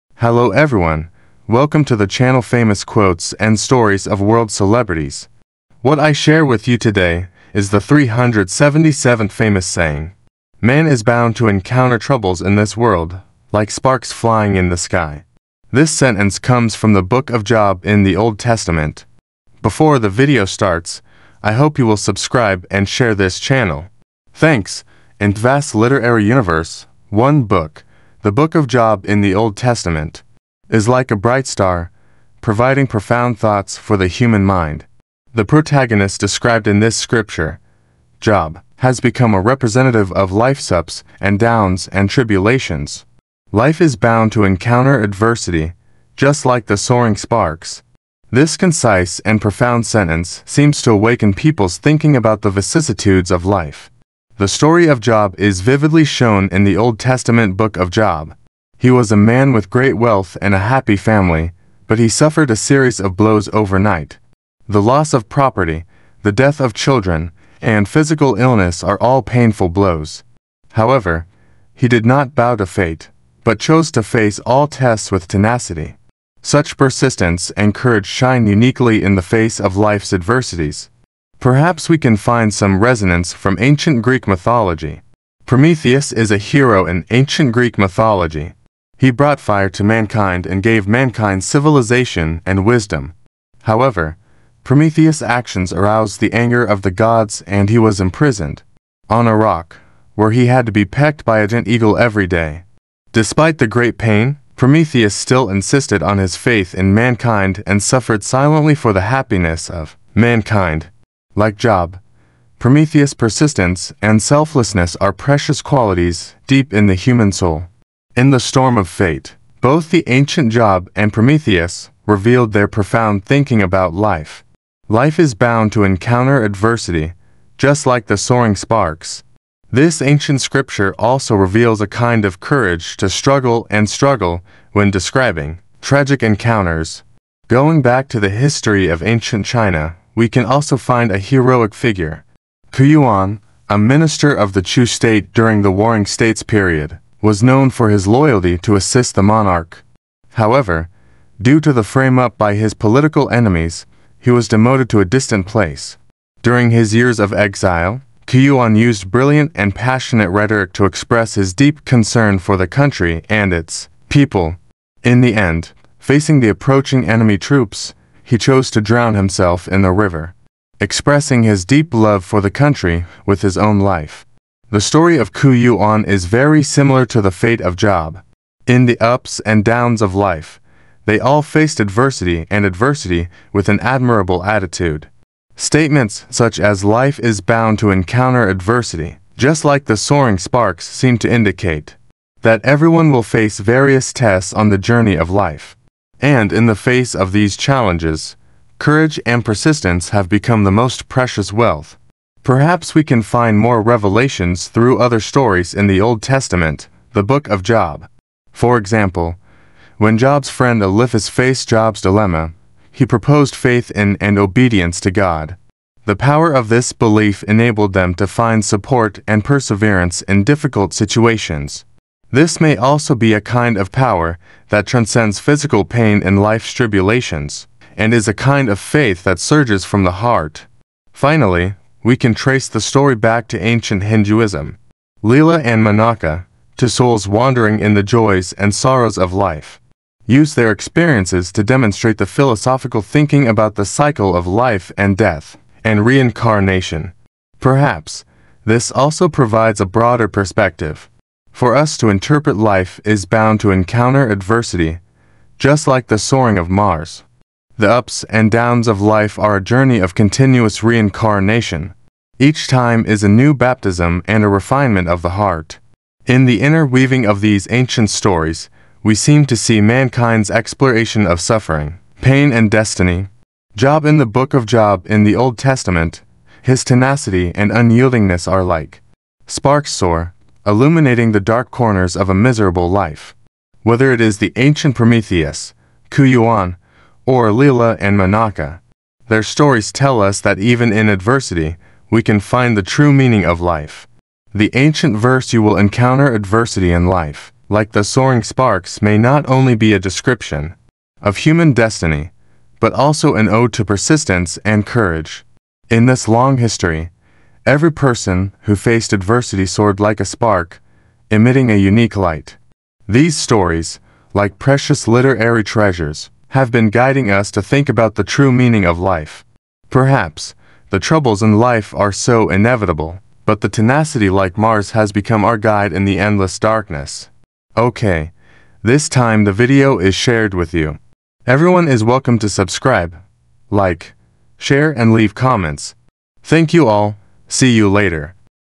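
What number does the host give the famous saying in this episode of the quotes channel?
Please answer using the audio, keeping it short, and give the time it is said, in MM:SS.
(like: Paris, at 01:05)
377th, at 00:07.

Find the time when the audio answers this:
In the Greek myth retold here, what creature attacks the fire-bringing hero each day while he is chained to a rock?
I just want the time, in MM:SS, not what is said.
01:41.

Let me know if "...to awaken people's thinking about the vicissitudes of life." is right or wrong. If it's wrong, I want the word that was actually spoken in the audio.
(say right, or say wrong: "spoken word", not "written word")
right.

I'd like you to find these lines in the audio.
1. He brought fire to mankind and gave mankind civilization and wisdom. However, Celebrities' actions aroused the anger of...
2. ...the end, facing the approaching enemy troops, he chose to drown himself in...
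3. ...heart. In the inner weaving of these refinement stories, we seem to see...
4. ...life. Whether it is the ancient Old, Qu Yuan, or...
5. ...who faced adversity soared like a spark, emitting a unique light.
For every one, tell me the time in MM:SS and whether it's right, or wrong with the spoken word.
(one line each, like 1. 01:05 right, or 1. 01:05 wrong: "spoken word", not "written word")
1. 01:28 wrong: "Prometheus", not "Celebrities"
2. 02:45 right
3. 04:25 wrong: "ancient", not "refinement"
4. 04:42 wrong: "Prometheus", not "Old"
5. 05:08 right.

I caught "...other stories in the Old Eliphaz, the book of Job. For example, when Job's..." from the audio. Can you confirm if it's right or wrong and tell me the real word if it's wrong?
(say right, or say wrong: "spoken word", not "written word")
wrong: "Testament", not "Eliphaz".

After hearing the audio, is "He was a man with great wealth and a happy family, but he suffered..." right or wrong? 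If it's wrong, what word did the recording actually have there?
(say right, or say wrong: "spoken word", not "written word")
right.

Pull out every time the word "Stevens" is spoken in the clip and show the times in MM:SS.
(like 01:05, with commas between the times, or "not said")
not said.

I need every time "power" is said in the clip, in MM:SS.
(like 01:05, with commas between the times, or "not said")
03:36, 03:43.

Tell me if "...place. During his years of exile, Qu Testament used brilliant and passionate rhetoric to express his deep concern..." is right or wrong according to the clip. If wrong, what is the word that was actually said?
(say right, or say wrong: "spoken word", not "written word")
wrong: "Yuan", not "Testament".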